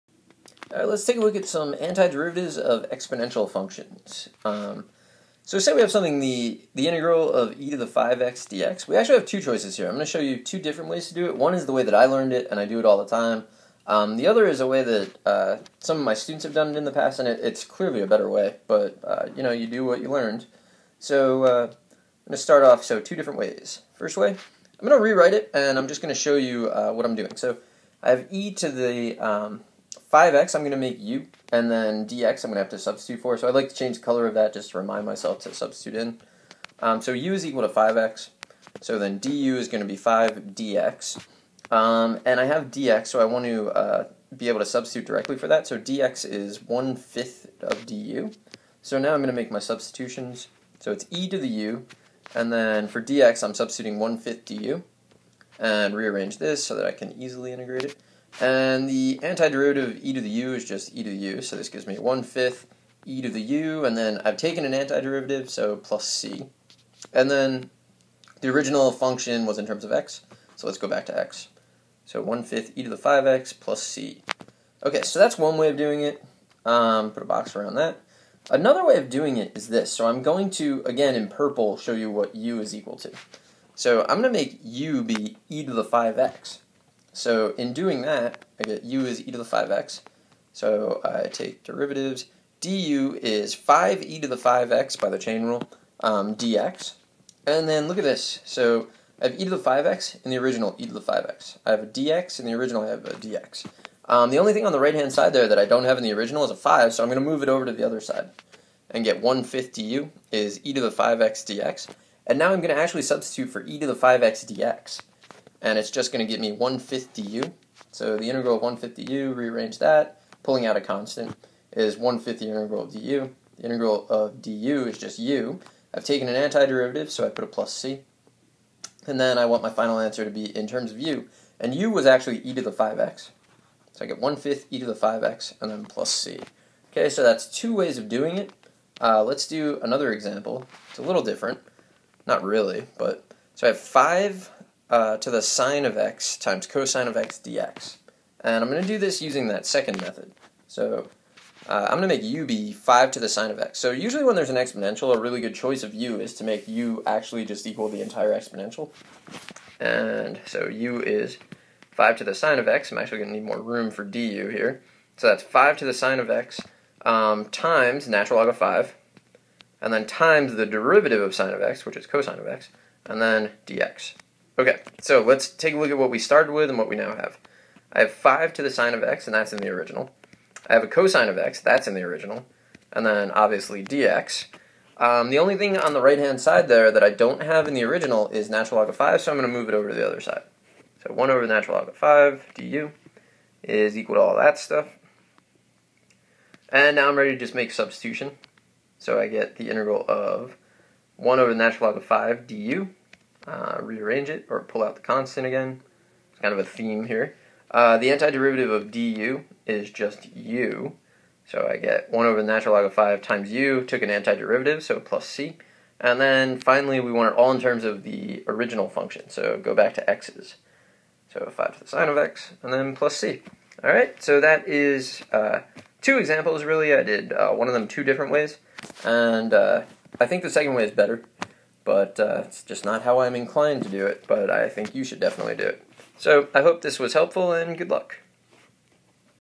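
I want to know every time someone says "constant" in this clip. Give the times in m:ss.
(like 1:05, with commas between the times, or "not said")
2:00, 3:25.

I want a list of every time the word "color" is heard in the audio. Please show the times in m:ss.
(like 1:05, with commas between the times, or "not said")
0:34.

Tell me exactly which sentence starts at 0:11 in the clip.
One is the way that I learned it, and I do it all the time.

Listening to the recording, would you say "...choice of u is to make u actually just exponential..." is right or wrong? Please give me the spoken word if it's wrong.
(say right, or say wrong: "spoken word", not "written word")
wrong: "equal", not "exponential".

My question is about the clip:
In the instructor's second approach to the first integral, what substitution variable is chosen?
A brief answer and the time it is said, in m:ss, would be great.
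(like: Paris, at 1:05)
e to the 5x, at 1:24.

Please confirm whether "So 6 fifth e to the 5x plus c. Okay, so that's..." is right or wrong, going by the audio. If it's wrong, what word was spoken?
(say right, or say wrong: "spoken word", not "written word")
wrong: "1", not "6".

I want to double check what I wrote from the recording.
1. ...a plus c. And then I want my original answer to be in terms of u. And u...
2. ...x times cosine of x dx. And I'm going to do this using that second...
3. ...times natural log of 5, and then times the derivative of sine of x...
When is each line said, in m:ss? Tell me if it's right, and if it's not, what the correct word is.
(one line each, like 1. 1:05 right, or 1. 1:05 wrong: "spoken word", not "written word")
1. 2:07 wrong: "final", not "original"
2. 2:25 right
3. 2:47 right.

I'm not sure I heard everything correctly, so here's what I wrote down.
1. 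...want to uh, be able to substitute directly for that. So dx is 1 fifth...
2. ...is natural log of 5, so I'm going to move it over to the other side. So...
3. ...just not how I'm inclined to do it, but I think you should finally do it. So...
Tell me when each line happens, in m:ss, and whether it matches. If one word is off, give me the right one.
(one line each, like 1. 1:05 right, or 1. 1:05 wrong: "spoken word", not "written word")
1. 0:43 right
2. 3:08 right
3. 3:52 wrong: "definitely", not "finally".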